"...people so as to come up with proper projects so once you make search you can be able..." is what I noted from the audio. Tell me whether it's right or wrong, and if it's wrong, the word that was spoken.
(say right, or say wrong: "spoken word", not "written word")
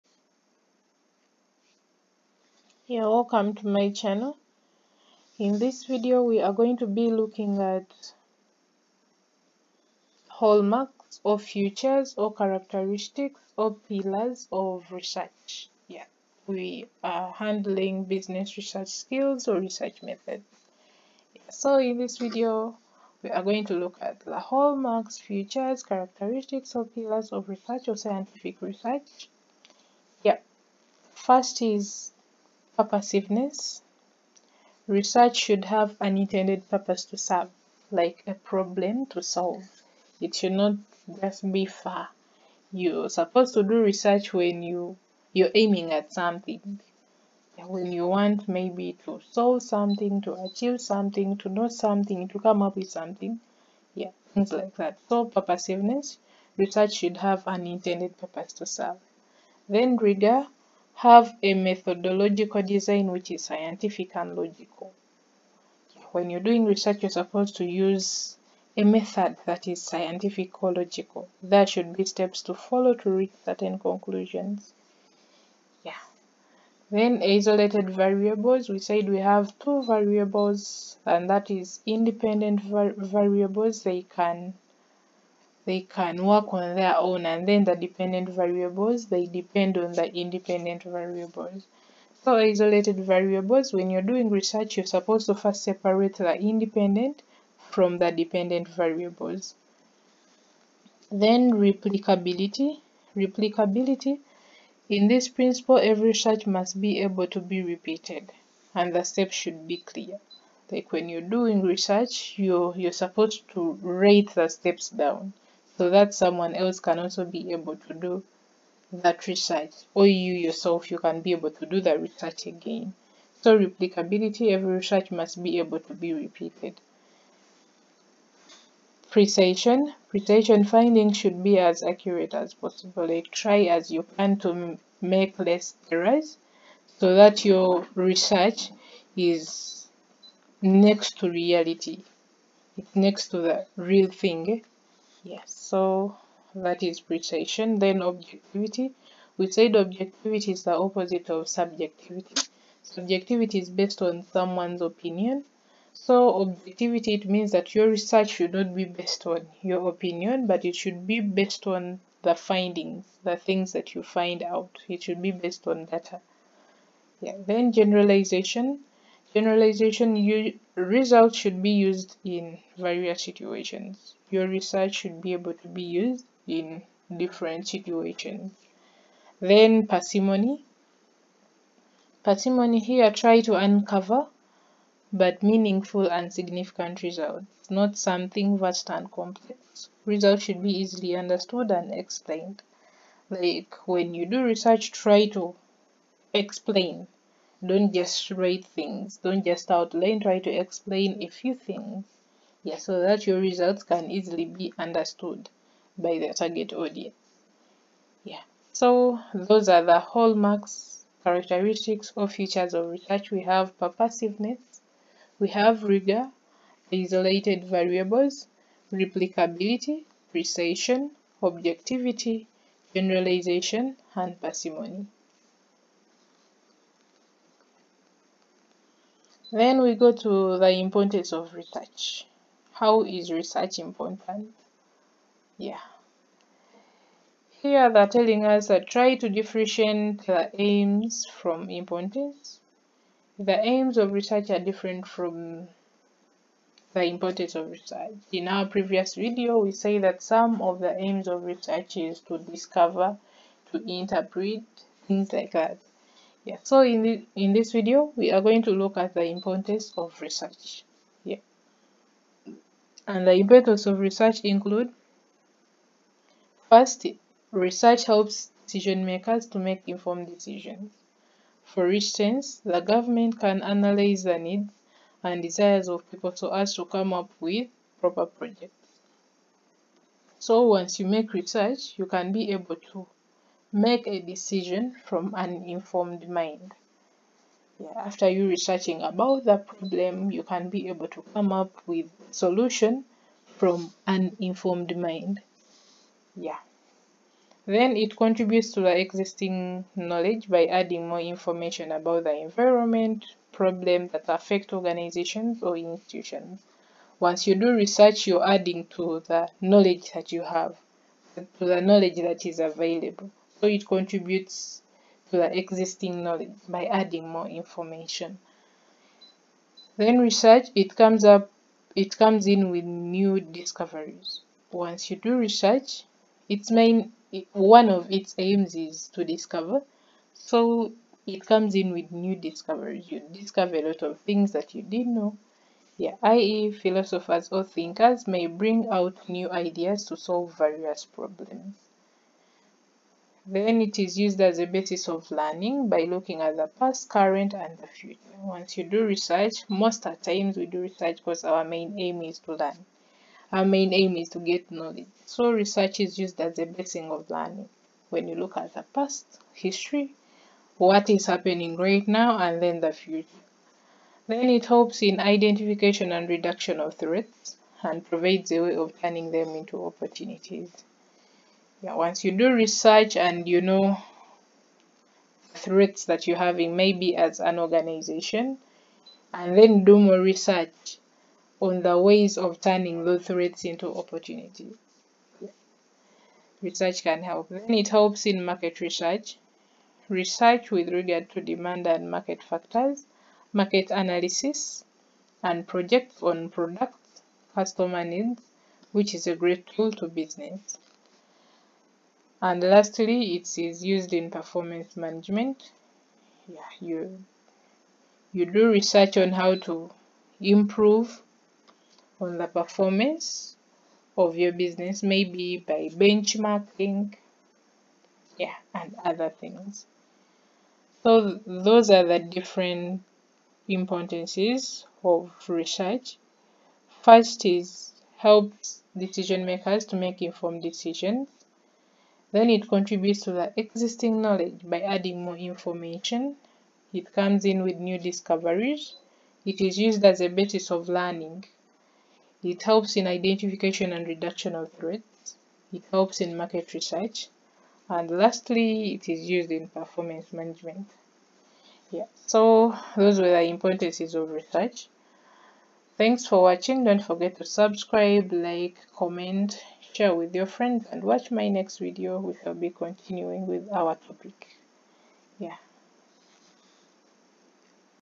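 wrong: "research", not "search".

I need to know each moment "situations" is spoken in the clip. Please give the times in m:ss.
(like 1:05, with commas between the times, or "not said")
2:53, 2:57.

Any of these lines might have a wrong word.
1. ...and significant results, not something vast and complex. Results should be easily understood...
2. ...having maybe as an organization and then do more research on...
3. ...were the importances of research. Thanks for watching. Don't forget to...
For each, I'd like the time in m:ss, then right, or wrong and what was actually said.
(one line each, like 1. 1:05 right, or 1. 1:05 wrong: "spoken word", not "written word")
1. 3:06 right
2. 6:16 right
3. 7:33 right.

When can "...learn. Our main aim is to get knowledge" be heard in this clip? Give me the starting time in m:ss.
5:52.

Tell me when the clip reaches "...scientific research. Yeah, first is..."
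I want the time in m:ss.
0:27.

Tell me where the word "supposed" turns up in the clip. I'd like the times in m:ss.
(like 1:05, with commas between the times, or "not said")
0:43, 1:07, 1:34, 1:52.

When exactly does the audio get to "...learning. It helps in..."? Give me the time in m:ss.
7:20.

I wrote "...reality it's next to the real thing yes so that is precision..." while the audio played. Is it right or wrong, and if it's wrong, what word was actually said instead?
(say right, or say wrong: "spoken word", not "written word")
right.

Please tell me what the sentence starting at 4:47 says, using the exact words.
Yeah, after you researching about the problem, you can be able to come up with solution from an informed mind.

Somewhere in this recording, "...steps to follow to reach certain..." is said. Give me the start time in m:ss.
1:12.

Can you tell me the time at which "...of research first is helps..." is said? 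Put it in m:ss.
7:05.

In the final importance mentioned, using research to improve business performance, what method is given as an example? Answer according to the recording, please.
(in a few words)
Benchmarking.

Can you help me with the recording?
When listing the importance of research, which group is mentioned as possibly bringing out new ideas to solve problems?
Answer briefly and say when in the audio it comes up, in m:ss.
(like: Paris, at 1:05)
Philosophers or thinkers, at 5:36.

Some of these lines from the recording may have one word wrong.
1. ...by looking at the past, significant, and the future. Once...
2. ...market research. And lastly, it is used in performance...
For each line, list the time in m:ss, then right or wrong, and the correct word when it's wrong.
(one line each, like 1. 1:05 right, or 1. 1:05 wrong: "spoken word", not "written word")
1. 5:45 wrong: "current", not "significant"
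2. 7:26 right.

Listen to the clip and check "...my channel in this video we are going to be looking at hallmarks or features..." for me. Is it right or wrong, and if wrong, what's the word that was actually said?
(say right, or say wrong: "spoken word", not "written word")
right.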